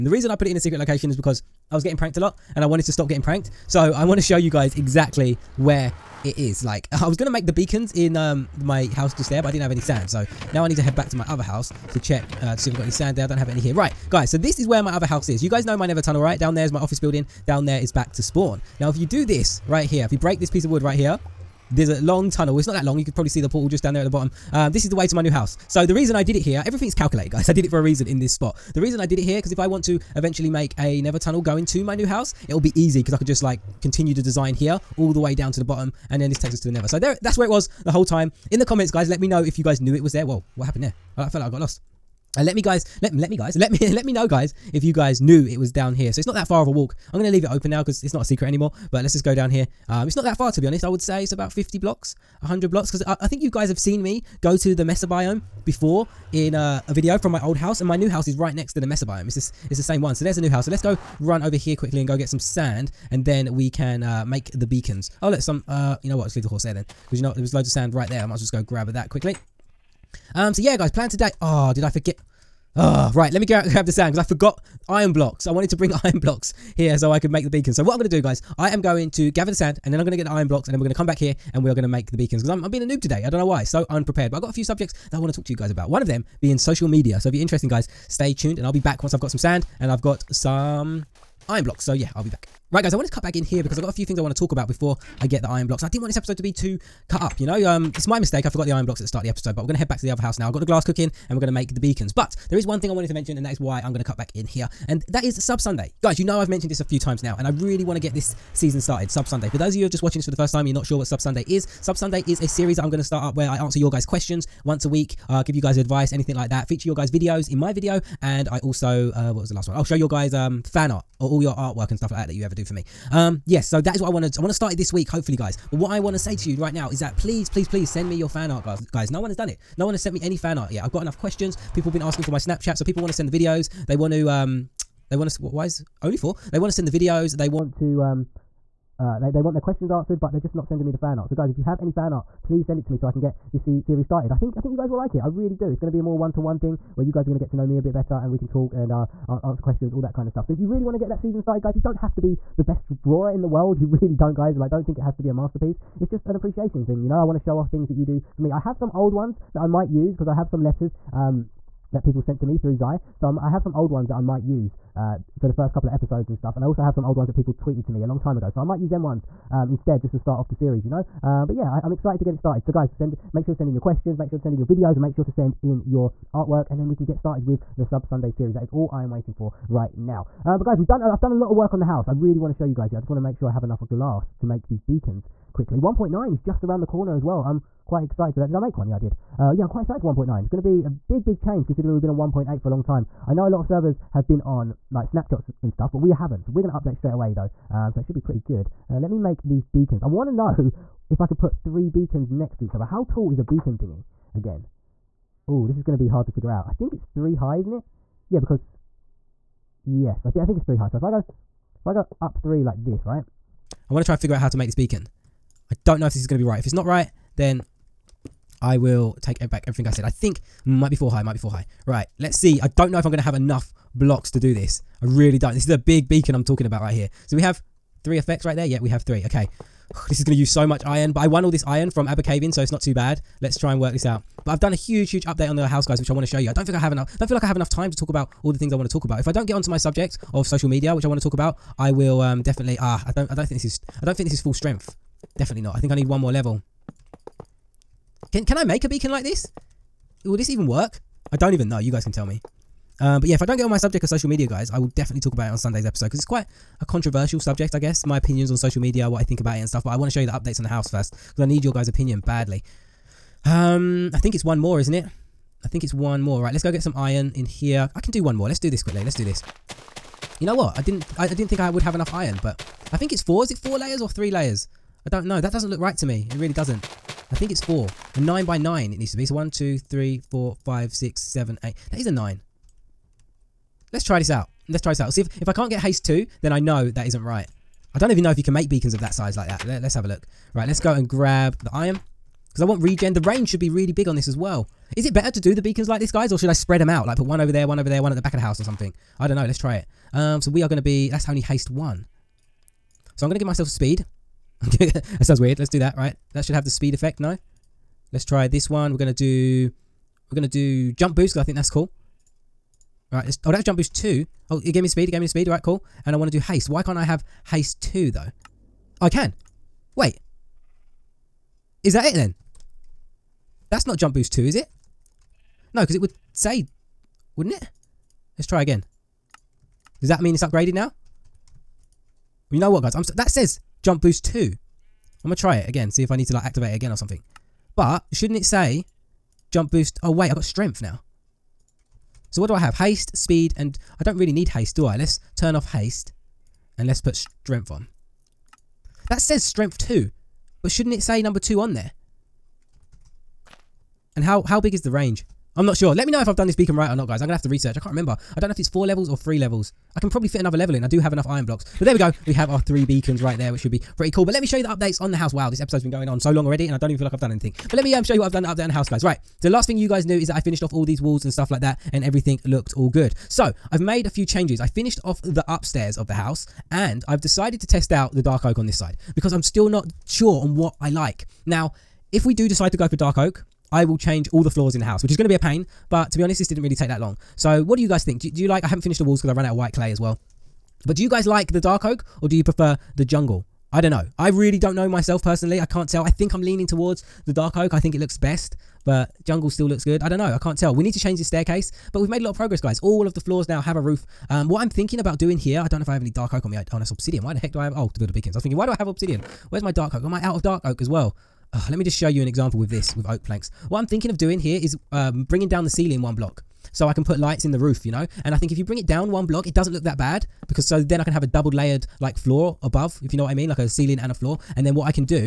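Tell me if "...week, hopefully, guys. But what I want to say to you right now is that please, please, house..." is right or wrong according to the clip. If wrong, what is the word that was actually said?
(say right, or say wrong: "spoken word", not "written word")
wrong: "please", not "house".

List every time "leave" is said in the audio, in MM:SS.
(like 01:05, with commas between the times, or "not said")
00:47, 01:06.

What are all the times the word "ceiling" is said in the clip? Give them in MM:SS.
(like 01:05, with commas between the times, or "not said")
06:55, 07:03.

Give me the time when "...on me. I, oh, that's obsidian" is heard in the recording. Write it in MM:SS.
06:46.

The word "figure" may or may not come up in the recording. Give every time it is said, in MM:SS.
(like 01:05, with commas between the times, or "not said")
03:26, 03:34.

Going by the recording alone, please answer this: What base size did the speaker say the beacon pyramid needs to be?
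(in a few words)
9 by 9.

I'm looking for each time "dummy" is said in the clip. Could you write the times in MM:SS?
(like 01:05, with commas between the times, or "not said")
not said.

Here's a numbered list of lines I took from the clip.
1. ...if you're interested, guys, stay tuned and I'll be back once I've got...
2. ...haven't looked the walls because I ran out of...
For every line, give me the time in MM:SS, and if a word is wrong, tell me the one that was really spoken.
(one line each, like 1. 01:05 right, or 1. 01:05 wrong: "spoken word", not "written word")
1. 01:27 right
2. 06:28 wrong: "finished", not "looked".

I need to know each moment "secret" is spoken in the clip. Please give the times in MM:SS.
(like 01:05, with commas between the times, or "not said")
00:00, 00:48.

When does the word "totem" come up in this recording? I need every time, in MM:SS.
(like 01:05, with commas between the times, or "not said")
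not said.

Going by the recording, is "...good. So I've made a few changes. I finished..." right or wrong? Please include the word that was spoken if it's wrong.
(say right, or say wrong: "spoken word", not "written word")
right.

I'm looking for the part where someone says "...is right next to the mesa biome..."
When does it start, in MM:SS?
00:58.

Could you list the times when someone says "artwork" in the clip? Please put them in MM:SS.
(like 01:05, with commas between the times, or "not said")
02:01, 02:56.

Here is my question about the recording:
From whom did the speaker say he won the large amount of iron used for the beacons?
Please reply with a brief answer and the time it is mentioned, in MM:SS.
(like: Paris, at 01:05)
Abercavian, at 03:52.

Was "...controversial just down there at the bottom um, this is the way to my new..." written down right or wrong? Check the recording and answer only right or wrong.
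wrong.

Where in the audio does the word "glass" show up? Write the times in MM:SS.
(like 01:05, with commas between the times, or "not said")
01:40, 03:03.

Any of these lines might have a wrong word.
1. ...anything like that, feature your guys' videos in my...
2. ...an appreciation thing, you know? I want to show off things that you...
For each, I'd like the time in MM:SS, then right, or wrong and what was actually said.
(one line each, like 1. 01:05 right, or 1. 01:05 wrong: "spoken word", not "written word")
1. 01:56 right
2. 02:36 right.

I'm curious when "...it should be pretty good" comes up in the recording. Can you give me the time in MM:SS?
03:17.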